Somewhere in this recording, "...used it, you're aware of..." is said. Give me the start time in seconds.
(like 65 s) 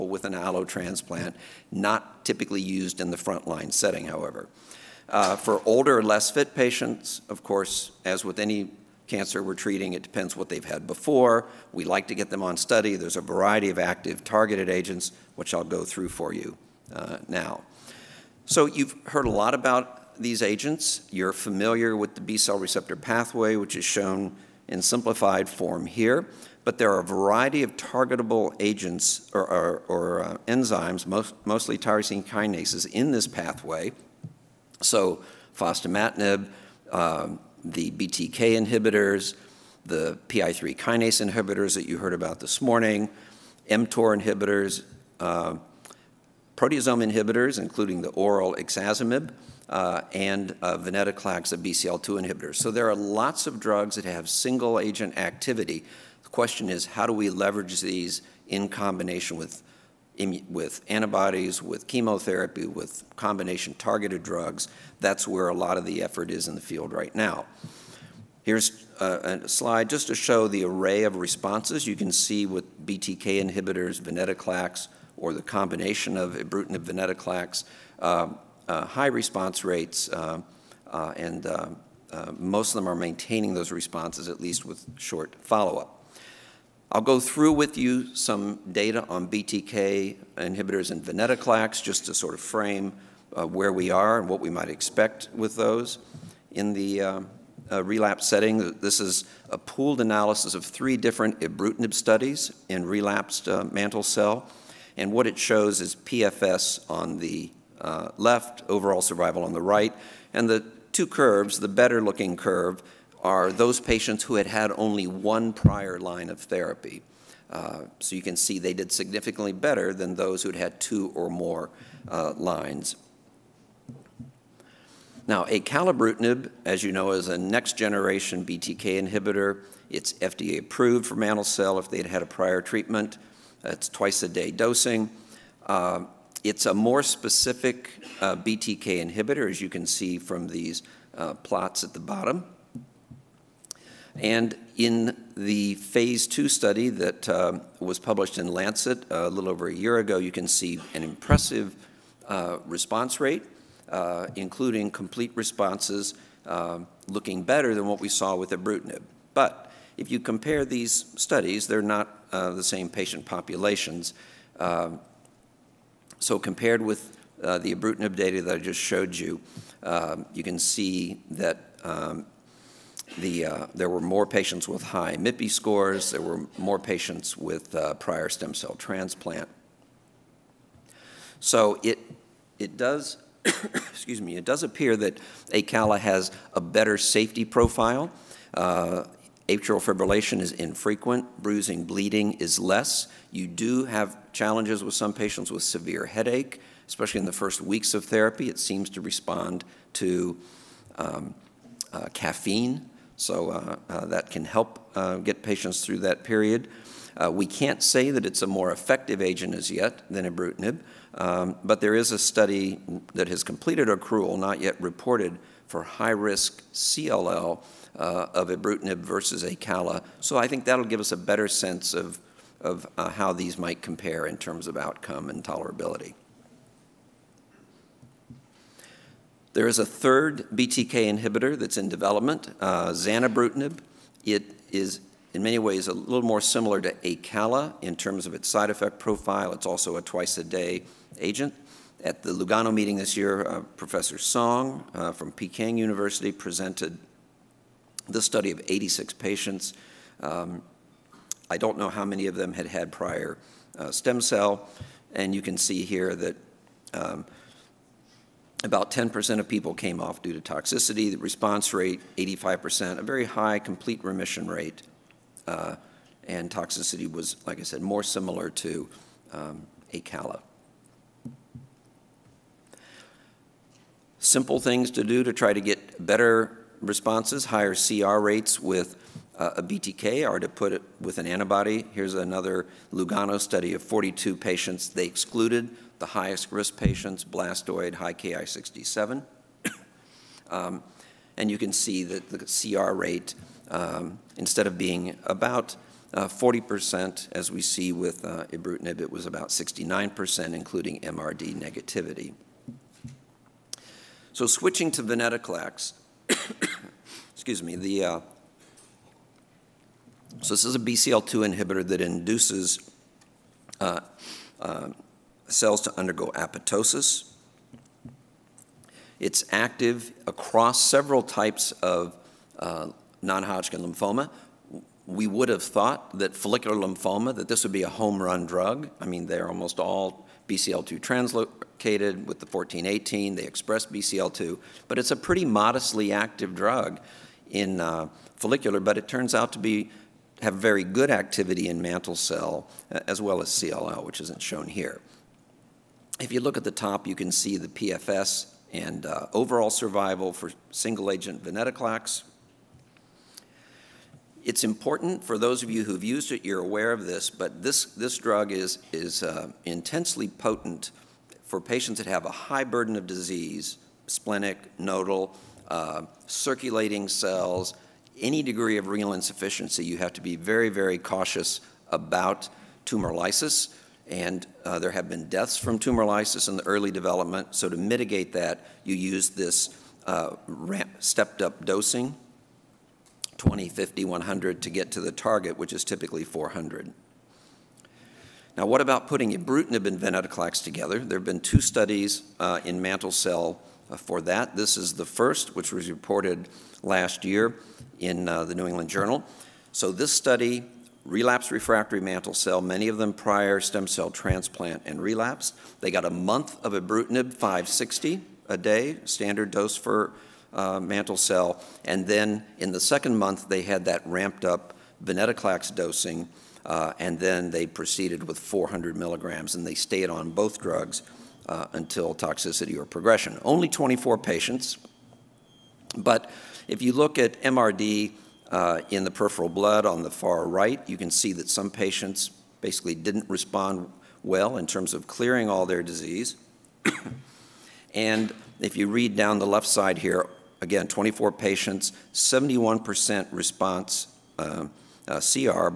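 356 s.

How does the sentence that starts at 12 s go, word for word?
There's a variety of active targeted agents, which I'll go through for you uh, now.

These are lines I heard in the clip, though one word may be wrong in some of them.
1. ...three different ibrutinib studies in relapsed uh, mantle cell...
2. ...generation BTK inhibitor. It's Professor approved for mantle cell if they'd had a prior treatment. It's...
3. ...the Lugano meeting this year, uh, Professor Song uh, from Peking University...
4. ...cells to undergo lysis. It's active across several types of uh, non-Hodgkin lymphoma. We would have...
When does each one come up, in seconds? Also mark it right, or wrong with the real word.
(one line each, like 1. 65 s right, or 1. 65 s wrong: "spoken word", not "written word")
1. 100 s right
2. 127 s wrong: "FDA", not "Professor"
3. 242 s right
4. 315 s wrong: "apoptosis", not "lysis".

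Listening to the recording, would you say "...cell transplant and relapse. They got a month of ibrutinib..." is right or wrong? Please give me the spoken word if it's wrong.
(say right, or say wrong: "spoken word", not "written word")
right.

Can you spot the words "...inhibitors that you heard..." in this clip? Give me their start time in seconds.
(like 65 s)
41 s.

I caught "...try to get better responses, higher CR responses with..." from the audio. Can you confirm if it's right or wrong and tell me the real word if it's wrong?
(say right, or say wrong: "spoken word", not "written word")
wrong: "rates", not "responses".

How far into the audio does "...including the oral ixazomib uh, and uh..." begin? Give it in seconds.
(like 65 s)
47 s.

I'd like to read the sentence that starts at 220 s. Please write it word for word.
So I think that'll give us a better sense of, of uh, how these might compare in terms of outcome and tolerability.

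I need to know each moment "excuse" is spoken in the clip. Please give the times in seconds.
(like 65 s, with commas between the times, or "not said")
183 s, 307 s.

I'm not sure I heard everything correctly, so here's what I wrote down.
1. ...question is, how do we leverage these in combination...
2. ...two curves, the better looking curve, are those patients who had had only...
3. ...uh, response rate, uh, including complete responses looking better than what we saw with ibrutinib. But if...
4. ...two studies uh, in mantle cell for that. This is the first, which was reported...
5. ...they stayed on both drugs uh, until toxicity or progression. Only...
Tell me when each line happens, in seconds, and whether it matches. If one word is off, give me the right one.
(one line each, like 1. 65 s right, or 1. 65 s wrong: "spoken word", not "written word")
1. 56 s right
2. 110 s right
3. 152 s right
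4. 391 s right
5. 419 s right.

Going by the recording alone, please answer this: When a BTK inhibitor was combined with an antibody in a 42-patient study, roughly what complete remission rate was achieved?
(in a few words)
69%.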